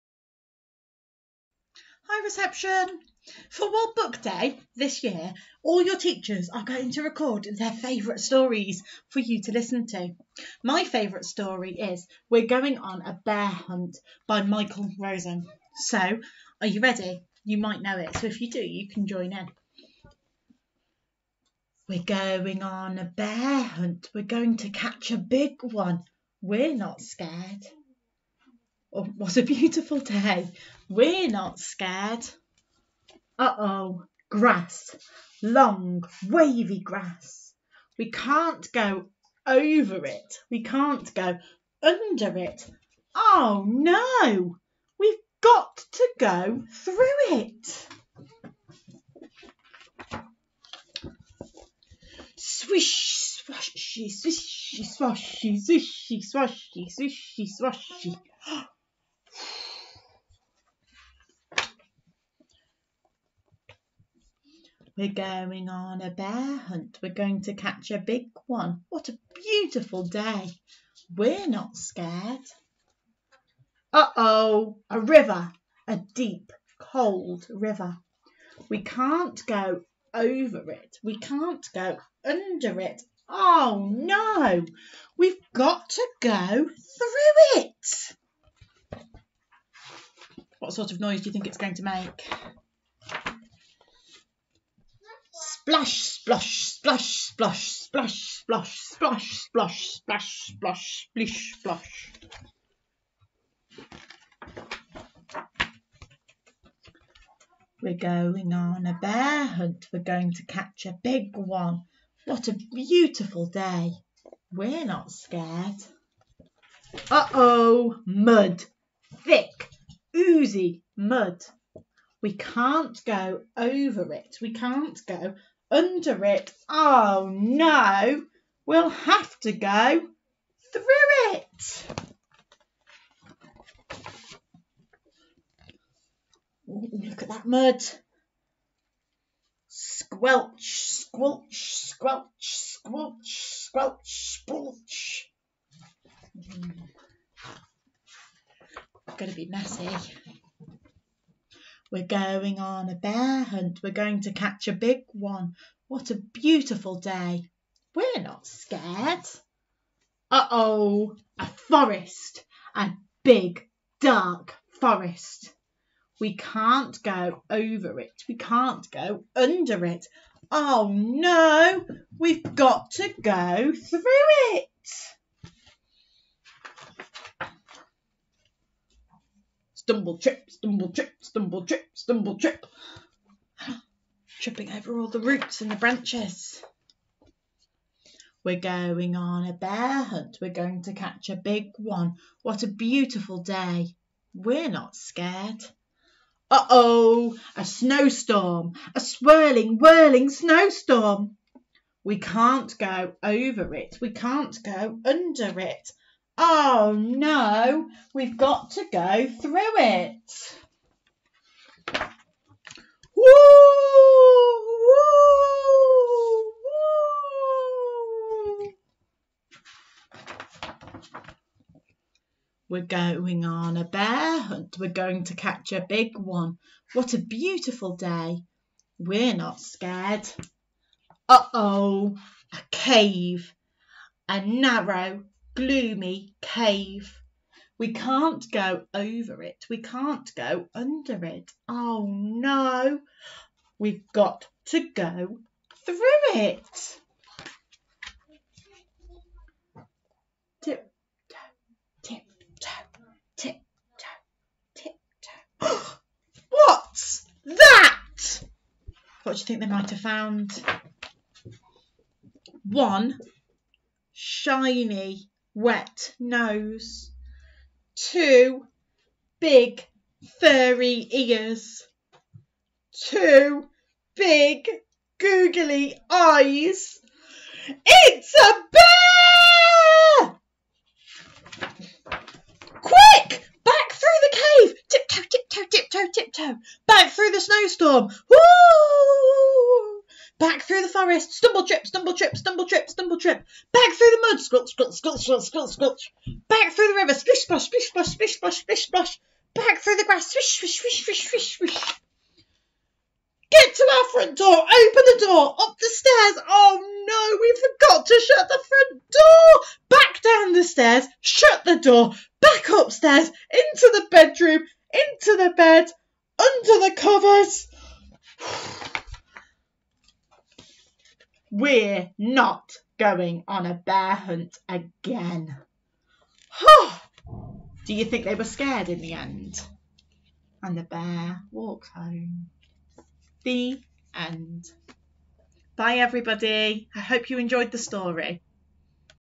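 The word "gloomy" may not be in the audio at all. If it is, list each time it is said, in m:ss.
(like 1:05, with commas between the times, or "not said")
3:55.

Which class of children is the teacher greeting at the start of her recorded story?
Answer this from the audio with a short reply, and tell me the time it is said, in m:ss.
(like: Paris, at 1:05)
Reception, at 0:02.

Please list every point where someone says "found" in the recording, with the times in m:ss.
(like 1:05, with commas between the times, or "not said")
4:19.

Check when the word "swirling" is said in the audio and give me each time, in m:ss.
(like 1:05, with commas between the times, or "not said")
3:18.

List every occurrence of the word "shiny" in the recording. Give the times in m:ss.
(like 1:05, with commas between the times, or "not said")
4:24.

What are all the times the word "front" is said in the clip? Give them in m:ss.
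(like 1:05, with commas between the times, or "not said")
5:04, 5:08.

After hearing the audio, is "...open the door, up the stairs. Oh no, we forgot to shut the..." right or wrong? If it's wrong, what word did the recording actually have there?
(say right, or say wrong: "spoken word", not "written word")
right.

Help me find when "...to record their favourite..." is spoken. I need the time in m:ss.
0:06.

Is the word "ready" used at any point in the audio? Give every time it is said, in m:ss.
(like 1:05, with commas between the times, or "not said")
0:16.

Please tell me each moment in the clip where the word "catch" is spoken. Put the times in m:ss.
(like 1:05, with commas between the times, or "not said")
0:24, 1:07, 1:50, 2:34, 3:10, 3:45.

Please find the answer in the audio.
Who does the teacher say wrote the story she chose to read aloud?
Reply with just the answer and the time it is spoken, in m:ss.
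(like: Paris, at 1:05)
Michael Rosen, at 0:14.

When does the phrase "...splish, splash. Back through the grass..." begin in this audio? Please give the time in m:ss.
4:58.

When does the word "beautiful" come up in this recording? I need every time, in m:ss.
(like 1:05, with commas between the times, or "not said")
0:29, 1:09, 1:52, 2:36, 3:12, 3:47.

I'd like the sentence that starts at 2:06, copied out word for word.
Oh no, we'll have to go through it.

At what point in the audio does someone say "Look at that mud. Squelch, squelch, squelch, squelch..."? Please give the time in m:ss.
2:16.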